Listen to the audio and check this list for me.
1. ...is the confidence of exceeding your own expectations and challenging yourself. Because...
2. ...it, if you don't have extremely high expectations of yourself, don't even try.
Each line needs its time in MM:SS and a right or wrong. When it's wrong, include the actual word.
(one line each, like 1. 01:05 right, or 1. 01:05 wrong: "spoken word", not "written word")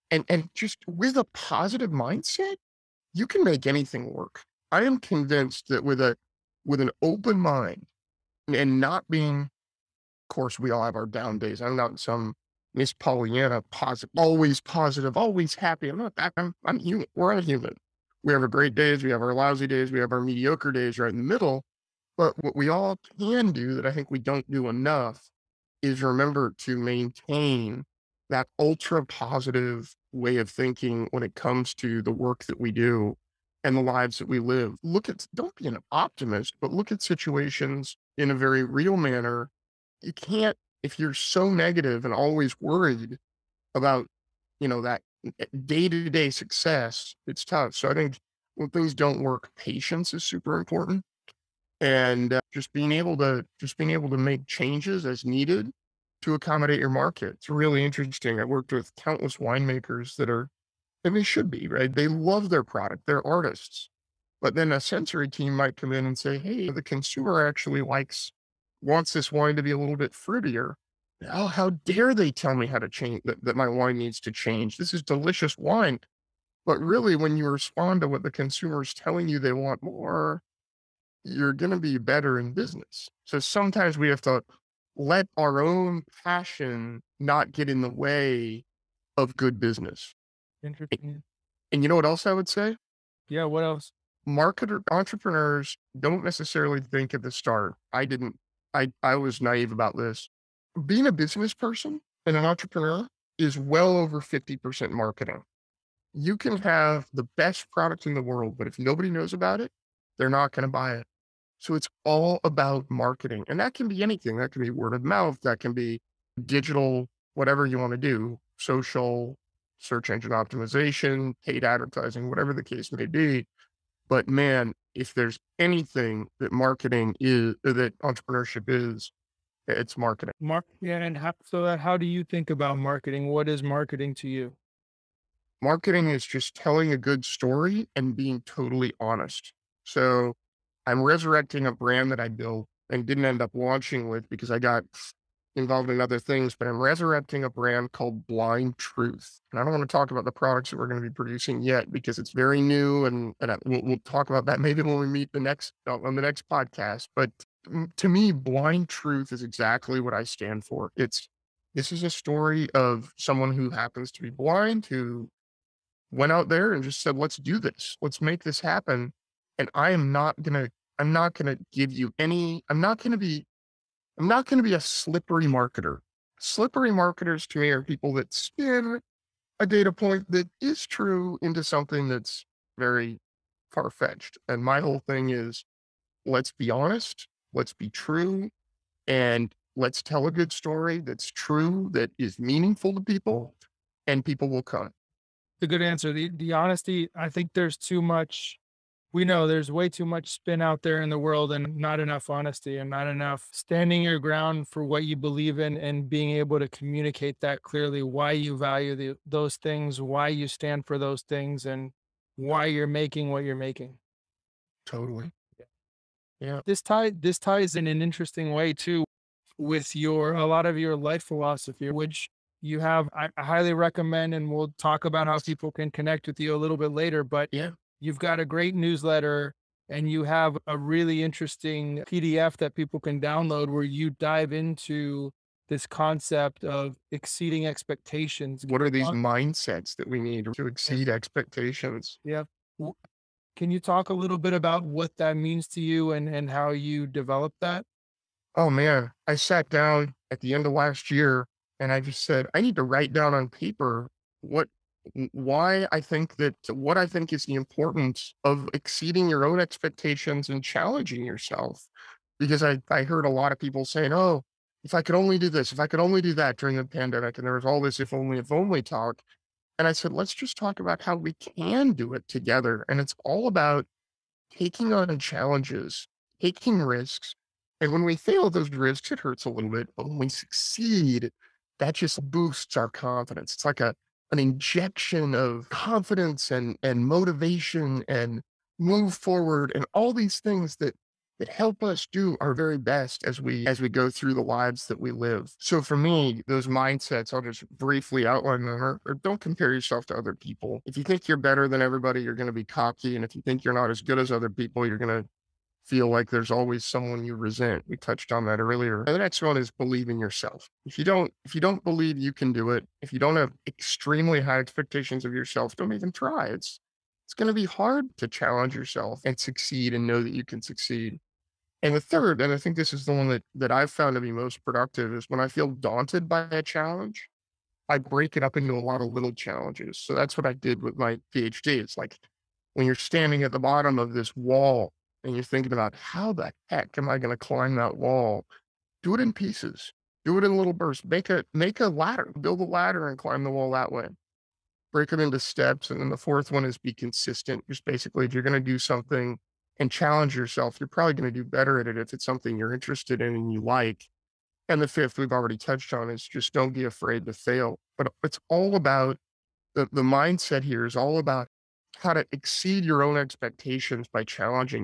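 1. 04:17 wrong: "importance", not "confidence"
2. 05:12 right.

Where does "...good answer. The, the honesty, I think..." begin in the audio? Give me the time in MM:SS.
03:15.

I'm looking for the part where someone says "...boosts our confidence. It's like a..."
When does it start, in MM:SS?
04:42.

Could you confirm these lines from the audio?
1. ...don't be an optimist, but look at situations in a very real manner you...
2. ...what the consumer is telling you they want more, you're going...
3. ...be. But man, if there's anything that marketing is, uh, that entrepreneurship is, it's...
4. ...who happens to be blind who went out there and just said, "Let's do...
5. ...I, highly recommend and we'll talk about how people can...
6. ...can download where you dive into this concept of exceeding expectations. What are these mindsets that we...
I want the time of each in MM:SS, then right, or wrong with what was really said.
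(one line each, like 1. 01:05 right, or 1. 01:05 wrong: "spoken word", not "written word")
1. 00:35 right
2. 01:18 right
3. 02:03 right
4. 02:43 right
5. 03:43 right
6. 03:52 right.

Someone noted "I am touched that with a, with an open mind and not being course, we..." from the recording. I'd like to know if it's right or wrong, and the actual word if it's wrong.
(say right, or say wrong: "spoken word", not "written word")
wrong: "convinced", not "touched".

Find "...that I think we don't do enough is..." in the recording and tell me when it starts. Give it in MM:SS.
00:23.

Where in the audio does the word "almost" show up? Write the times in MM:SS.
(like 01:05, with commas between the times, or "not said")
not said.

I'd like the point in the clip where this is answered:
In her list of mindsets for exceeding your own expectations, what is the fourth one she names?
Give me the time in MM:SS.
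05:46.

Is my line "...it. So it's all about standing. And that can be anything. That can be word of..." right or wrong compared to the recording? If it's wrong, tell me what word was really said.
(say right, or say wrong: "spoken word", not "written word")
wrong: "marketing", not "standing".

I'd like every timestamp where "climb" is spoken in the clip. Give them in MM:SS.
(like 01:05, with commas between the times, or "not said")
05:37, 05:43.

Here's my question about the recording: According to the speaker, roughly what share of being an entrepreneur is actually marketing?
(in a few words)
over 50%.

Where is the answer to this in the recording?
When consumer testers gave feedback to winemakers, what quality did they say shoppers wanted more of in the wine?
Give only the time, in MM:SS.
01:10.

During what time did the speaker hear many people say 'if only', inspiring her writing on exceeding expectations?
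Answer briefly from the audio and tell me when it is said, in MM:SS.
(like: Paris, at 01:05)
the pandemic, at 04:26.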